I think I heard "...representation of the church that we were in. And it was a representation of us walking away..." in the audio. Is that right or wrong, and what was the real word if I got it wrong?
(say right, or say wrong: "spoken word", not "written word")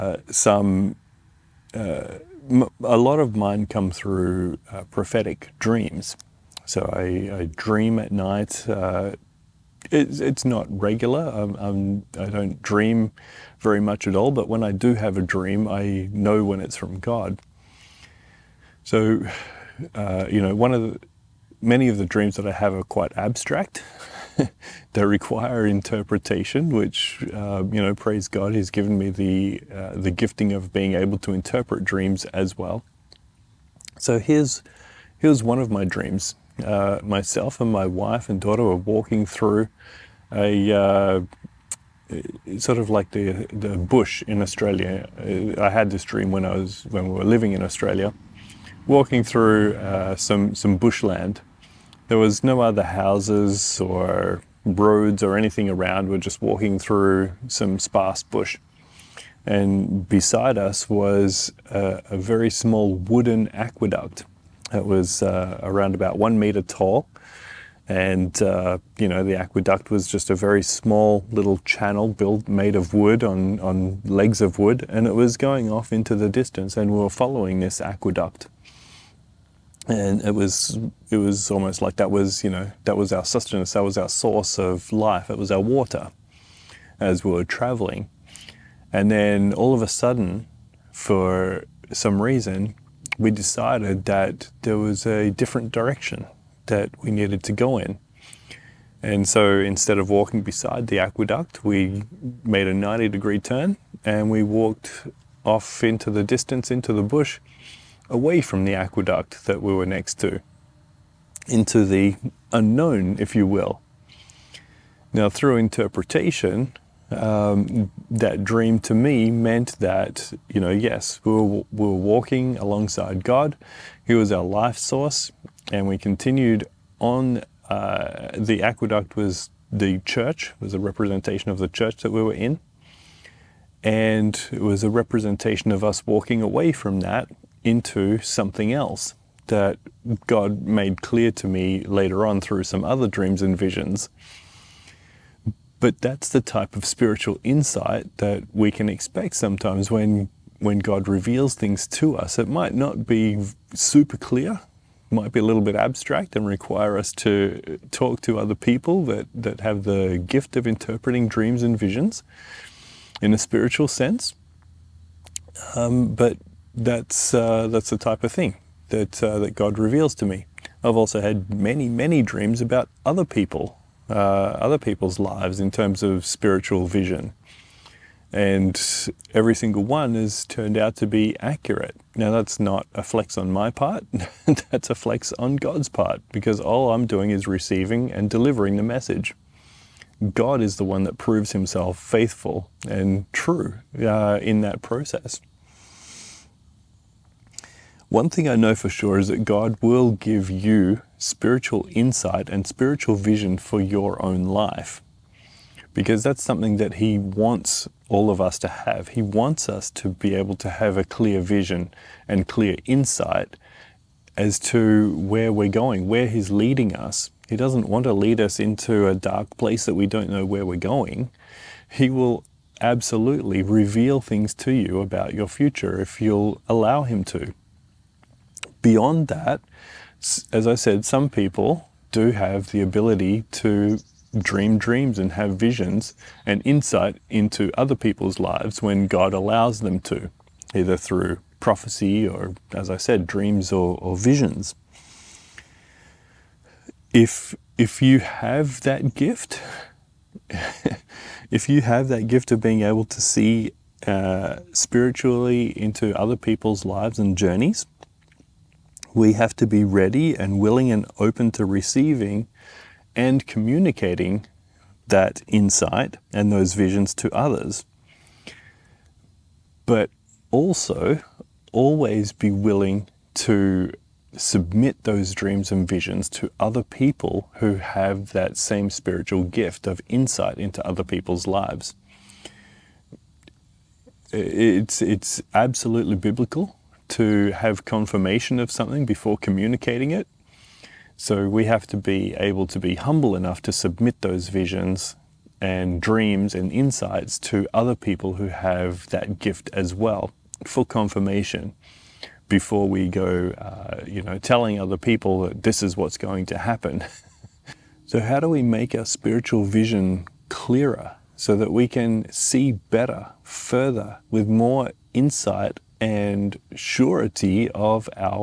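right.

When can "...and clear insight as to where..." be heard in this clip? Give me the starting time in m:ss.
3:32.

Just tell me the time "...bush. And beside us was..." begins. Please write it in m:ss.
0:58.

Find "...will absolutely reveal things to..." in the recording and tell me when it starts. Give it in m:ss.
3:42.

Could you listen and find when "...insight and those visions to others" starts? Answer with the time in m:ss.
4:25.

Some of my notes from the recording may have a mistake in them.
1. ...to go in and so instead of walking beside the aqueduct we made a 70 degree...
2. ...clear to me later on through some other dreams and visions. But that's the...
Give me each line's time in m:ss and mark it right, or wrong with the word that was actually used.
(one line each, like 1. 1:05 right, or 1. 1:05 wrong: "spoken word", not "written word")
1. 1:37 wrong: "90", not "70"
2. 2:21 right.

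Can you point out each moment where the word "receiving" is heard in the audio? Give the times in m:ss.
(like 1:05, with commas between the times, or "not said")
3:07, 4:21.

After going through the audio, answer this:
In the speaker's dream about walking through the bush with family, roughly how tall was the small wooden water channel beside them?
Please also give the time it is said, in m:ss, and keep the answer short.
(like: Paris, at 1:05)
1 meter, at 1:06.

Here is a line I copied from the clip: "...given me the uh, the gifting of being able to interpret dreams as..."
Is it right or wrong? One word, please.
right.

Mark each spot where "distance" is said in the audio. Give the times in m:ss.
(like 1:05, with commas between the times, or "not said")
1:16, 1:46.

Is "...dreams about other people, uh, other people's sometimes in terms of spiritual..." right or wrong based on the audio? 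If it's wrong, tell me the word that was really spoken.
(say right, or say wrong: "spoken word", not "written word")
wrong: "lives", not "sometimes".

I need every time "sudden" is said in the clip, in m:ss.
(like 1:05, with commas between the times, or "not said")
1:29.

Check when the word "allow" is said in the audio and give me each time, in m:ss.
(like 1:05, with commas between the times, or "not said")
3:46, 3:59.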